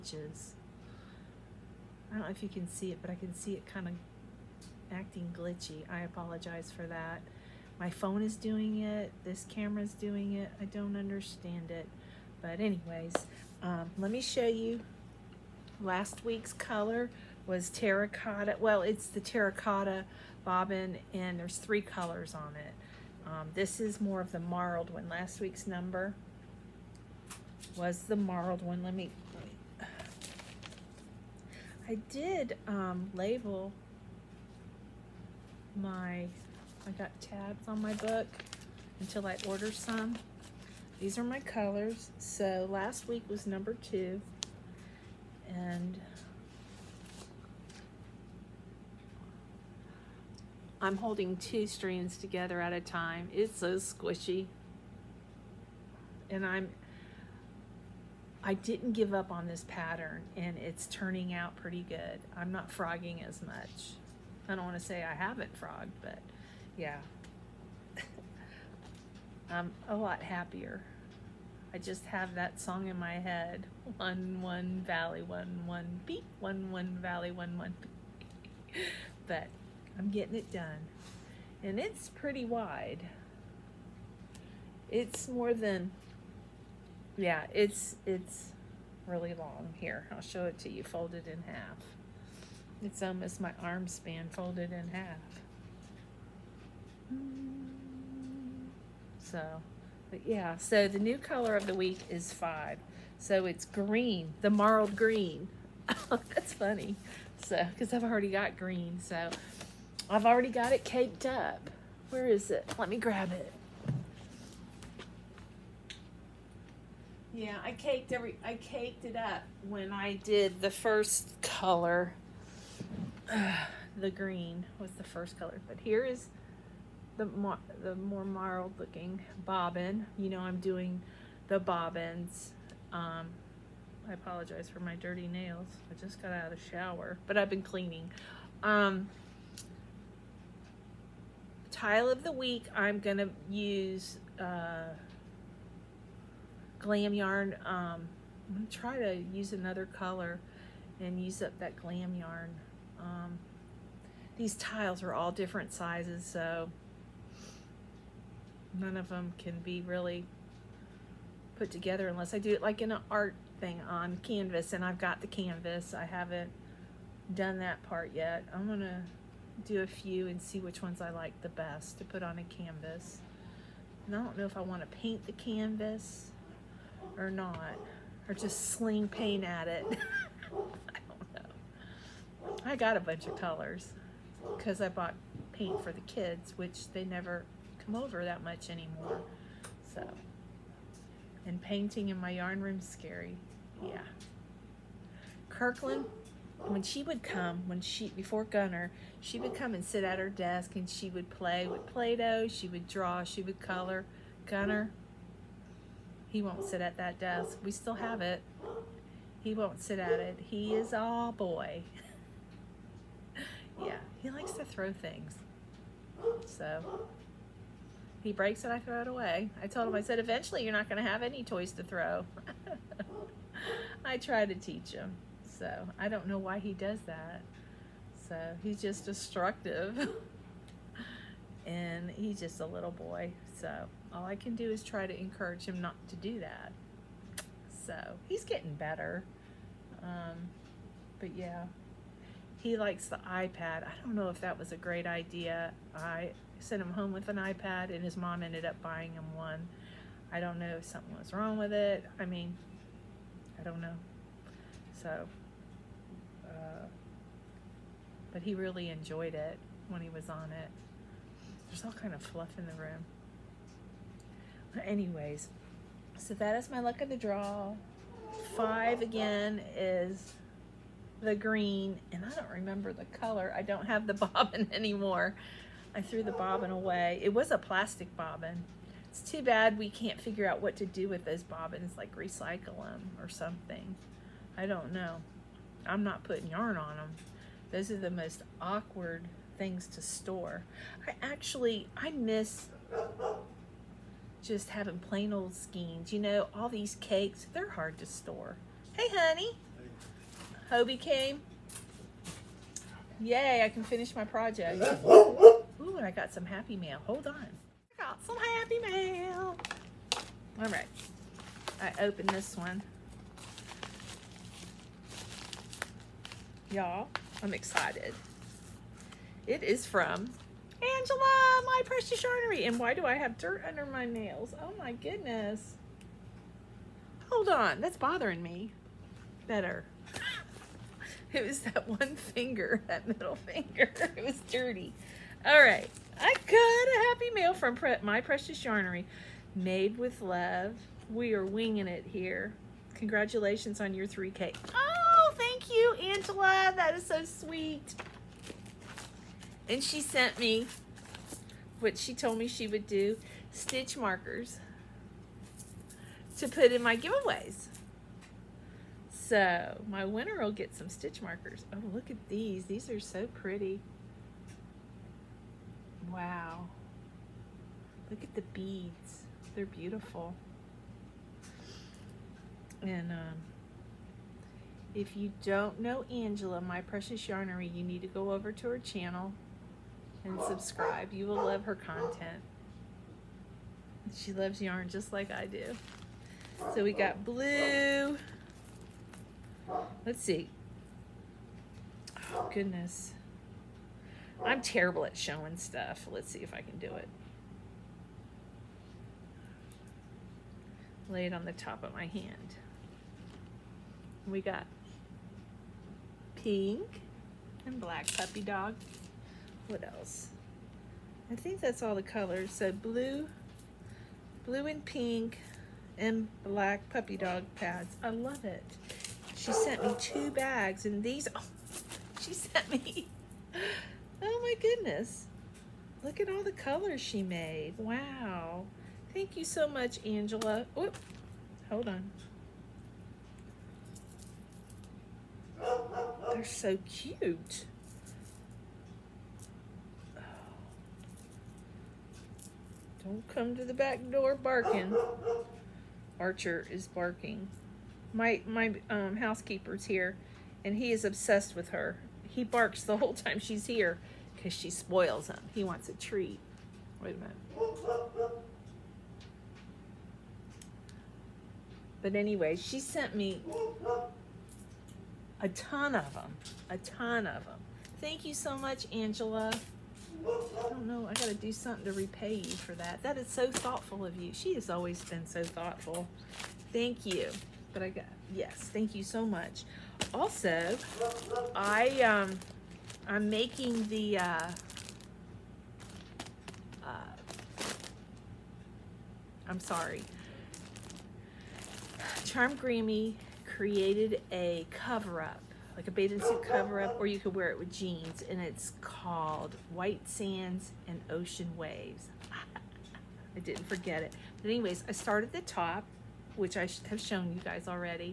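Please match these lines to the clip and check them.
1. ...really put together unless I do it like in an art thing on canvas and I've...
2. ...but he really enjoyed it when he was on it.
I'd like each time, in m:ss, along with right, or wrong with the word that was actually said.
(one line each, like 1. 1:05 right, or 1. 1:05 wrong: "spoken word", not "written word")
1. 2:39 right
2. 4:18 right.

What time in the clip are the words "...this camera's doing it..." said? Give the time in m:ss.
0:09.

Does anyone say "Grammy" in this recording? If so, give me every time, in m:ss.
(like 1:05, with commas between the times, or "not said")
8:12.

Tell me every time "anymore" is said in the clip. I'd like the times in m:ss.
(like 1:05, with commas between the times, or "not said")
3:08, 4:34.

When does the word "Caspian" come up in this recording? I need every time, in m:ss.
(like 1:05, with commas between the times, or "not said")
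not said.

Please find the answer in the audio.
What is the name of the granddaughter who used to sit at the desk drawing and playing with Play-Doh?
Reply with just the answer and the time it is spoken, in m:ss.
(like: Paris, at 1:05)
Kirkland, at 3:15.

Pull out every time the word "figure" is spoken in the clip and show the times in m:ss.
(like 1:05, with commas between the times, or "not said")
4:40.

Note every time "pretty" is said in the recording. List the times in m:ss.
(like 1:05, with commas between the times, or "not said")
1:01, 1:22, 6:03.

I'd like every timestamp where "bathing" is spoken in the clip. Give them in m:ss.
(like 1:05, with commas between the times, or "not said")
8:15.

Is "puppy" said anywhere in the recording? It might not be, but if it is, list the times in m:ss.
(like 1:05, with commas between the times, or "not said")
6:48, 6:56.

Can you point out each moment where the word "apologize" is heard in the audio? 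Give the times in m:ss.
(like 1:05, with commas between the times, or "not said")
0:05, 2:14.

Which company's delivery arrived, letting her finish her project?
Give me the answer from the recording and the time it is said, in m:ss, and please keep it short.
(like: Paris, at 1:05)
Hobbii, at 5:00.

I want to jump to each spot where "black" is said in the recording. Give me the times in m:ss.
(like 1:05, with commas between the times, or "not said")
6:47, 6:56.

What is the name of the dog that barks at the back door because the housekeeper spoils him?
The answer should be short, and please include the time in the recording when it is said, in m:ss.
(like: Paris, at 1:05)
Archer, at 7:26.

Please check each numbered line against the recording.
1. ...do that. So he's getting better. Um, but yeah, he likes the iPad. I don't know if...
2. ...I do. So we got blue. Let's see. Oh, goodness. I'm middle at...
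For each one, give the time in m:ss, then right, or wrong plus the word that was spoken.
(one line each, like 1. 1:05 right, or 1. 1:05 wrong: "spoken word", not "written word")
1. 3:56 right
2. 6:25 wrong: "terrible", not "middle".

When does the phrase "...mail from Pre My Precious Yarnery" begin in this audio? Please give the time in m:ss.
5:37.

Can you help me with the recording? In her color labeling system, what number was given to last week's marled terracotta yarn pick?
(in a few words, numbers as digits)
2.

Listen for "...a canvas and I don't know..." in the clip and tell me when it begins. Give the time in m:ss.
2:52.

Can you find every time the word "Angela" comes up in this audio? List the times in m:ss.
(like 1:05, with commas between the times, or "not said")
5:20, 5:46, 6:16, 7:10, 7:48.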